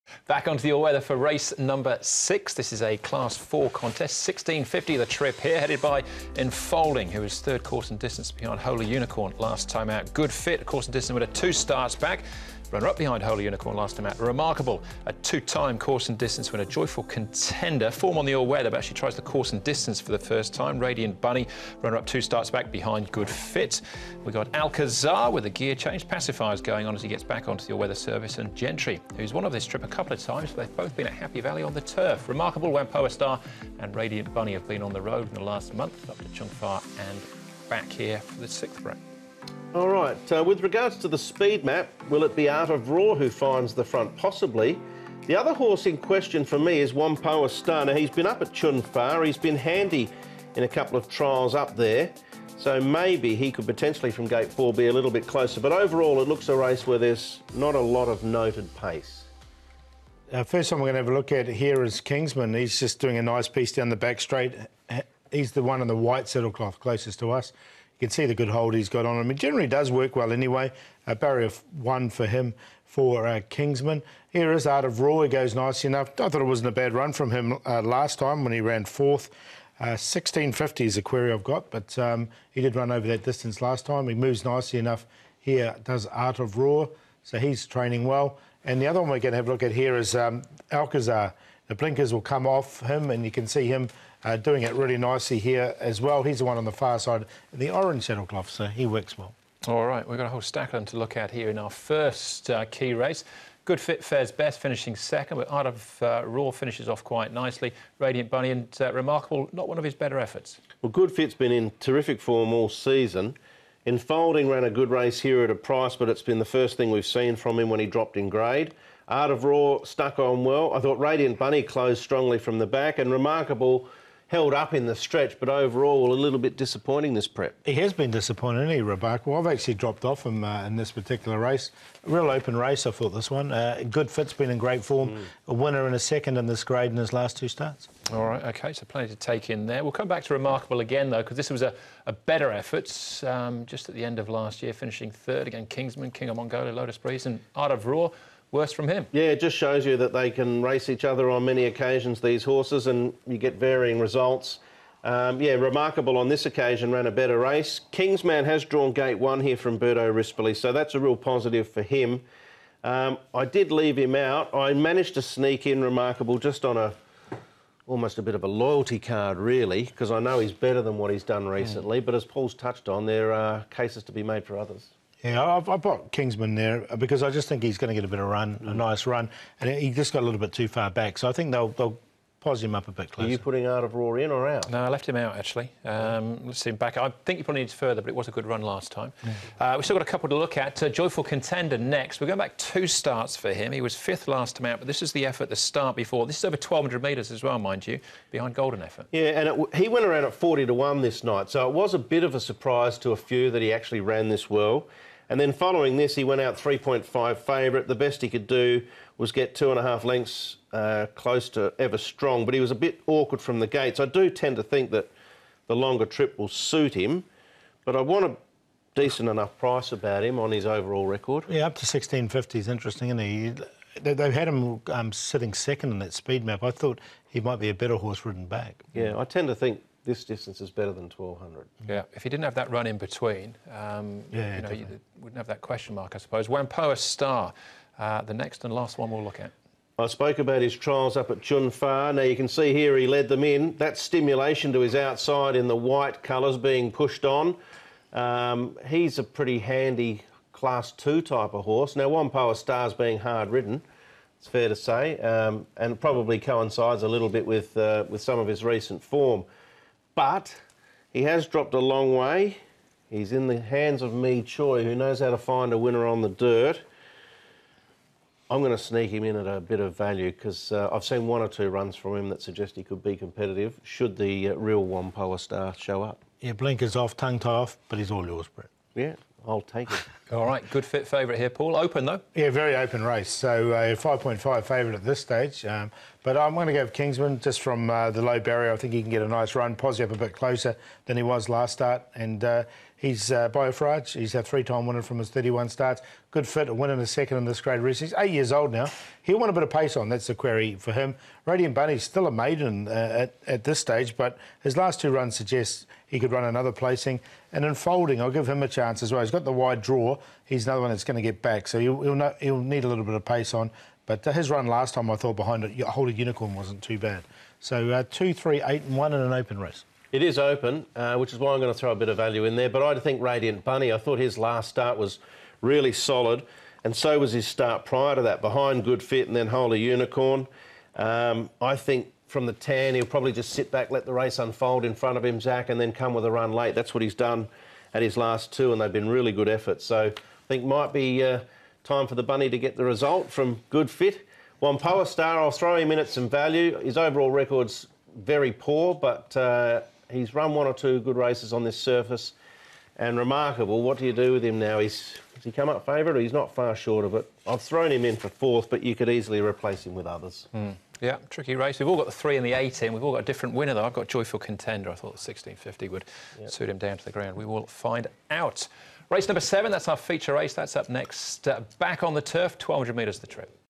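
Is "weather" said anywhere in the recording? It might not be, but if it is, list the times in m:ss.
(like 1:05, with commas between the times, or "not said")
0:00, 0:18, 0:27.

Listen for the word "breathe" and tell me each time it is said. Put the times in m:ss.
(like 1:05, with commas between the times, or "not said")
not said.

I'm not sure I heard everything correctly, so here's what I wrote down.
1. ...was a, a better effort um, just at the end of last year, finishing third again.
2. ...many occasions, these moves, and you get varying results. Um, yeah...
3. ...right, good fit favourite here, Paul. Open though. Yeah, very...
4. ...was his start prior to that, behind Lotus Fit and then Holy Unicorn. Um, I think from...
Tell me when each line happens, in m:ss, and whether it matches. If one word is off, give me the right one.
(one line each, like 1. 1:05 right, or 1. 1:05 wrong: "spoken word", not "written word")
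1. 2:21 right
2. 2:31 wrong: "horses", not "moves"
3. 4:40 right
4. 5:27 wrong: "Good", not "Lotus".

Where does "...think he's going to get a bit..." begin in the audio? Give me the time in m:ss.
2:57.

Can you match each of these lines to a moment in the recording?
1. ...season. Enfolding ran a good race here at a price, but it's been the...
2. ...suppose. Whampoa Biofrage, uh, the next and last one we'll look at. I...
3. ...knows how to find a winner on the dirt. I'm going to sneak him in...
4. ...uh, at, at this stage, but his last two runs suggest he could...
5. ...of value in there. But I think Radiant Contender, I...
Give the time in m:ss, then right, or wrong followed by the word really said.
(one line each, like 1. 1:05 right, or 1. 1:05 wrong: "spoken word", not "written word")
1. 1:52 right
2. 3:56 wrong: "Star", not "Biofrage"
3. 4:24 right
4. 5:02 right
5. 5:22 wrong: "Bunny", not "Contender".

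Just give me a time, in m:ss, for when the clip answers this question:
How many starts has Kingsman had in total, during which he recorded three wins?
4:55.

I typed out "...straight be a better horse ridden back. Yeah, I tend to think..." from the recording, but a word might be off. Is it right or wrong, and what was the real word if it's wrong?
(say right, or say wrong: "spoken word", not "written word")
wrong: "might", not "straight".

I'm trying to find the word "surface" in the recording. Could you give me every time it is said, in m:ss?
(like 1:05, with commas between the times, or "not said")
5:51.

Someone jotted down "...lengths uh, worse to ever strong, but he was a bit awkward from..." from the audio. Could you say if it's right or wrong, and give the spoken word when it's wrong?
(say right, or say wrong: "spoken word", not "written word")
wrong: "close", not "worse".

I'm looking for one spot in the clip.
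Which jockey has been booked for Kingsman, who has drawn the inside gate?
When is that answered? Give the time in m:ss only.
2:39.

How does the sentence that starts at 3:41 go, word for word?
Yeah, up to 1650 is interesting, isn't he?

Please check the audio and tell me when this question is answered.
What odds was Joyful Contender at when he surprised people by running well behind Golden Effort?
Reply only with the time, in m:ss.
3:20.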